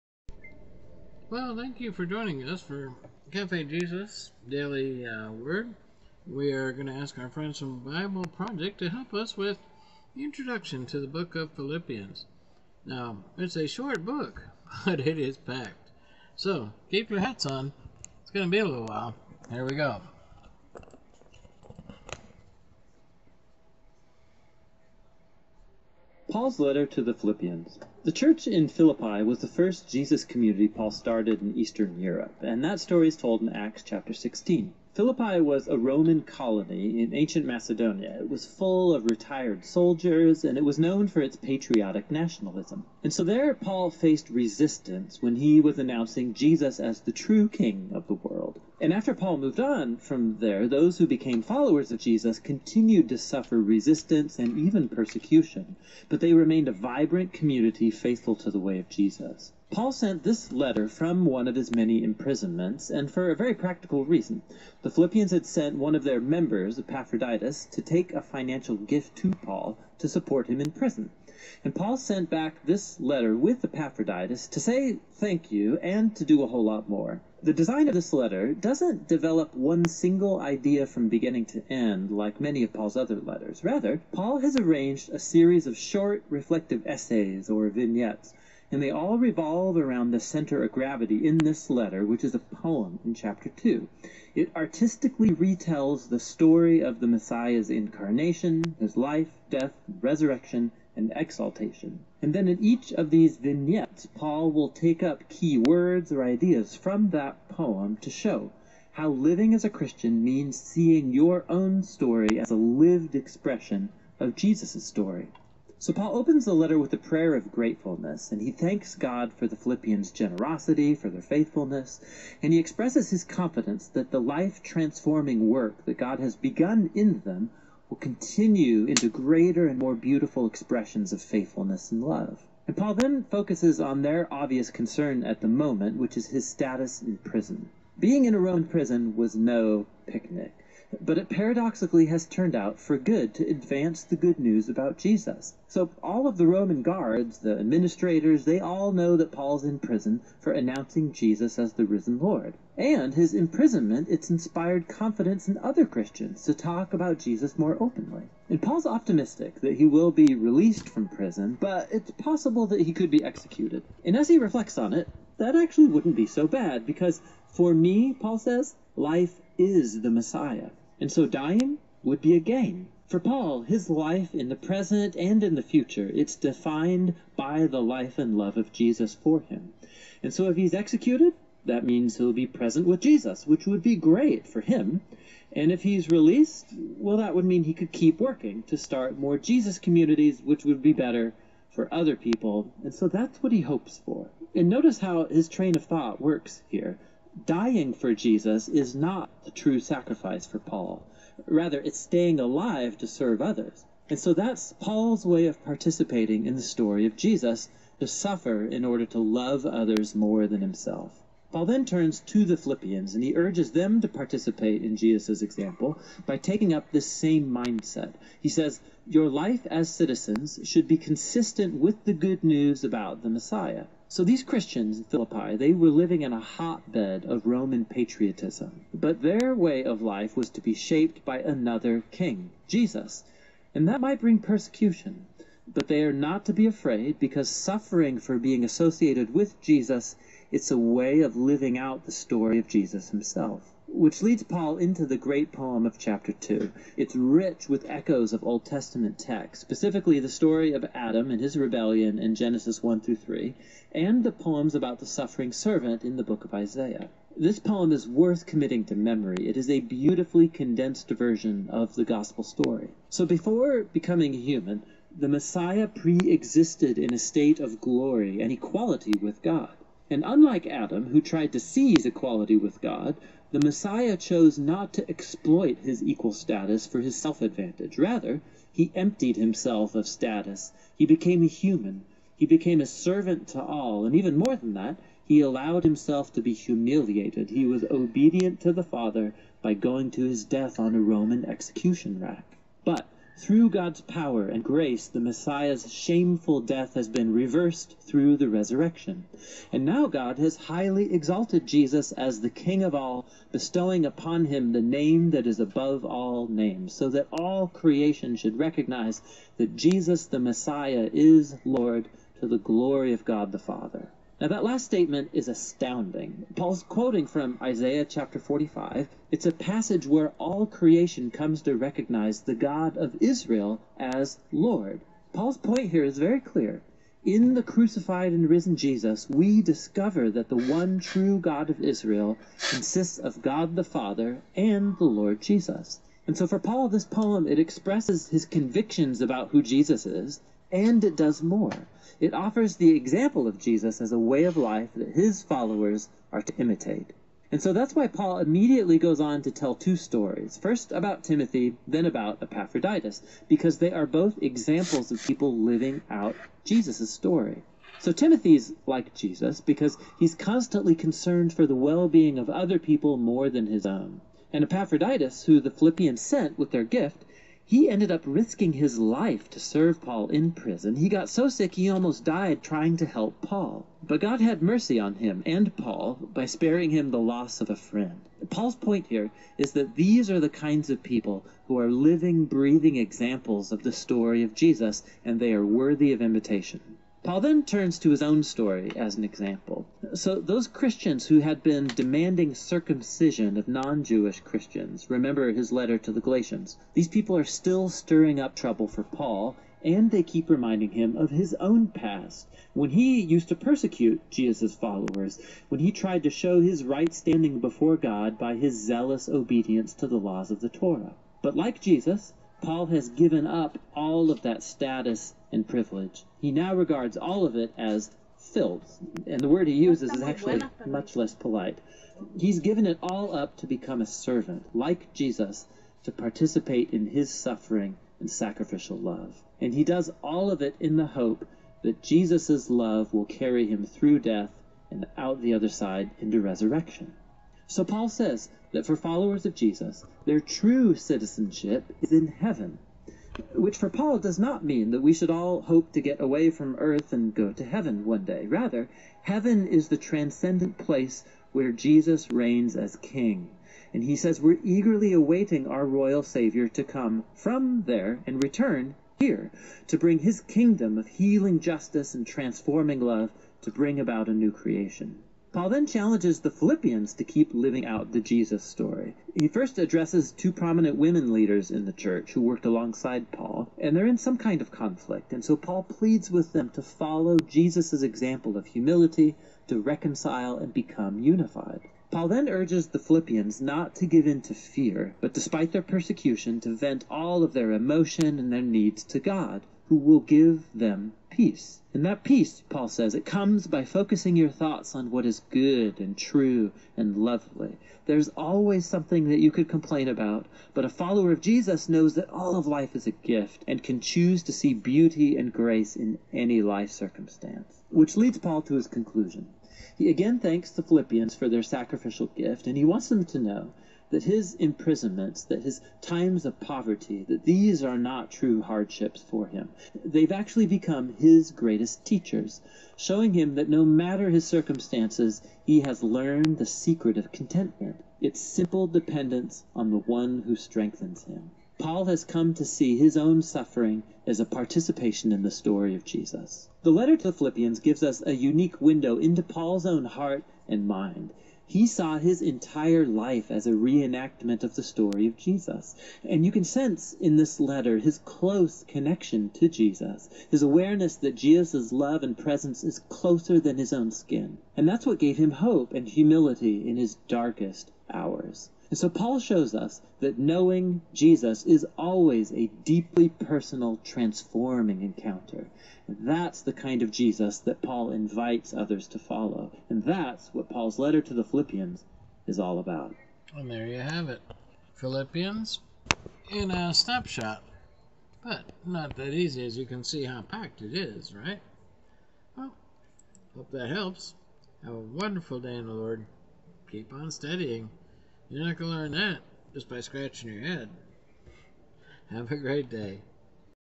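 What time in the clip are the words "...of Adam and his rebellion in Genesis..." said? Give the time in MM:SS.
04:10.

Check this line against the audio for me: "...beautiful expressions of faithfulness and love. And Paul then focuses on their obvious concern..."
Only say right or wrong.
right.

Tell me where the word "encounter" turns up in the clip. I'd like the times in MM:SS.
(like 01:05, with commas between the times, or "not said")
09:25.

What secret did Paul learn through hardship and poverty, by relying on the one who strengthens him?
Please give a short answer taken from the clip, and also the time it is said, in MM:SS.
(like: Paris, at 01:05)
Contentment, at 08:47.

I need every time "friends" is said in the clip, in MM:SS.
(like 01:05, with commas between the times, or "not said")
00:07, 06:17.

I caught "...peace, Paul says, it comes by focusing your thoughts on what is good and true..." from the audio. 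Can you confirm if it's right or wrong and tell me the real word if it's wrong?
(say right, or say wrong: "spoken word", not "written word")
right.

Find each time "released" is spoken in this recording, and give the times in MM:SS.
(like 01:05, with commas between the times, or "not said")
02:40, 03:06.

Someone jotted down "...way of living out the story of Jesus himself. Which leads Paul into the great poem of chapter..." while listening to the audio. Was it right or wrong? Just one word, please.
right.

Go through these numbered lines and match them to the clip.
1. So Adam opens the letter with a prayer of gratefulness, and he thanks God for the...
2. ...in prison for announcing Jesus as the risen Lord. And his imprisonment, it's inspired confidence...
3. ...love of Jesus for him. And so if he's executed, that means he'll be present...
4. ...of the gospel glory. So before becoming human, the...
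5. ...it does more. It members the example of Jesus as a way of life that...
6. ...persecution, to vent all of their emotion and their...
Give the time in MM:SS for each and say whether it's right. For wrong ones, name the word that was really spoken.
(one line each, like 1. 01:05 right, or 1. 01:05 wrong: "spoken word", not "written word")
1. 01:55 wrong: "Paul", not "Adam"
2. 02:29 right
3. 02:58 right
4. 04:21 wrong: "story", not "glory"
5. 05:41 wrong: "offers", not "members"
6. 08:05 right.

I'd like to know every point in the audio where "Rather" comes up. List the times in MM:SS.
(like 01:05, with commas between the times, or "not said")
01:23, 03:21, 04:37, 07:28.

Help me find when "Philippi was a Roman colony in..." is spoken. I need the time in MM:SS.
00:34.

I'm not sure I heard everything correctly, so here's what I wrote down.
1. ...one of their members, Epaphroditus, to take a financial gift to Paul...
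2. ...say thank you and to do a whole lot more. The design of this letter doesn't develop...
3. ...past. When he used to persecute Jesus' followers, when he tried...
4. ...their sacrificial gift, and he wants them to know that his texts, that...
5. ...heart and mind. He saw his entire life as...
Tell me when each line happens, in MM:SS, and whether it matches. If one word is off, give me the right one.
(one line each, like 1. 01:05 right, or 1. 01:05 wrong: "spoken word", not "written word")
1. 01:05 right
2. 01:14 right
3. 06:41 right
4. 08:31 wrong: "imprisonments", not "texts"
5. 09:00 right.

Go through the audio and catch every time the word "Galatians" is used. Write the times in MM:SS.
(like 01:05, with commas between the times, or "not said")
06:36.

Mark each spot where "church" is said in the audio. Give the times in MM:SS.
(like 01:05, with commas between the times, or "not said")
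00:28, 07:51.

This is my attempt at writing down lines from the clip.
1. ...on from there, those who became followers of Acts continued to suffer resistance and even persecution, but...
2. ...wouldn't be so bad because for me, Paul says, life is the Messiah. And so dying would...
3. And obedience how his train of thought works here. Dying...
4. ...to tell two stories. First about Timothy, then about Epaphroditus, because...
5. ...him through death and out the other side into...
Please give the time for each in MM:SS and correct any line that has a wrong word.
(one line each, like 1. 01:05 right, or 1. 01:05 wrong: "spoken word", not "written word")
1. 00:49 wrong: "Jesus", not "Acts"
2. 02:45 right
3. 03:14 wrong: "notice", not "obedience"
4. 05:49 right
5. 07:13 right.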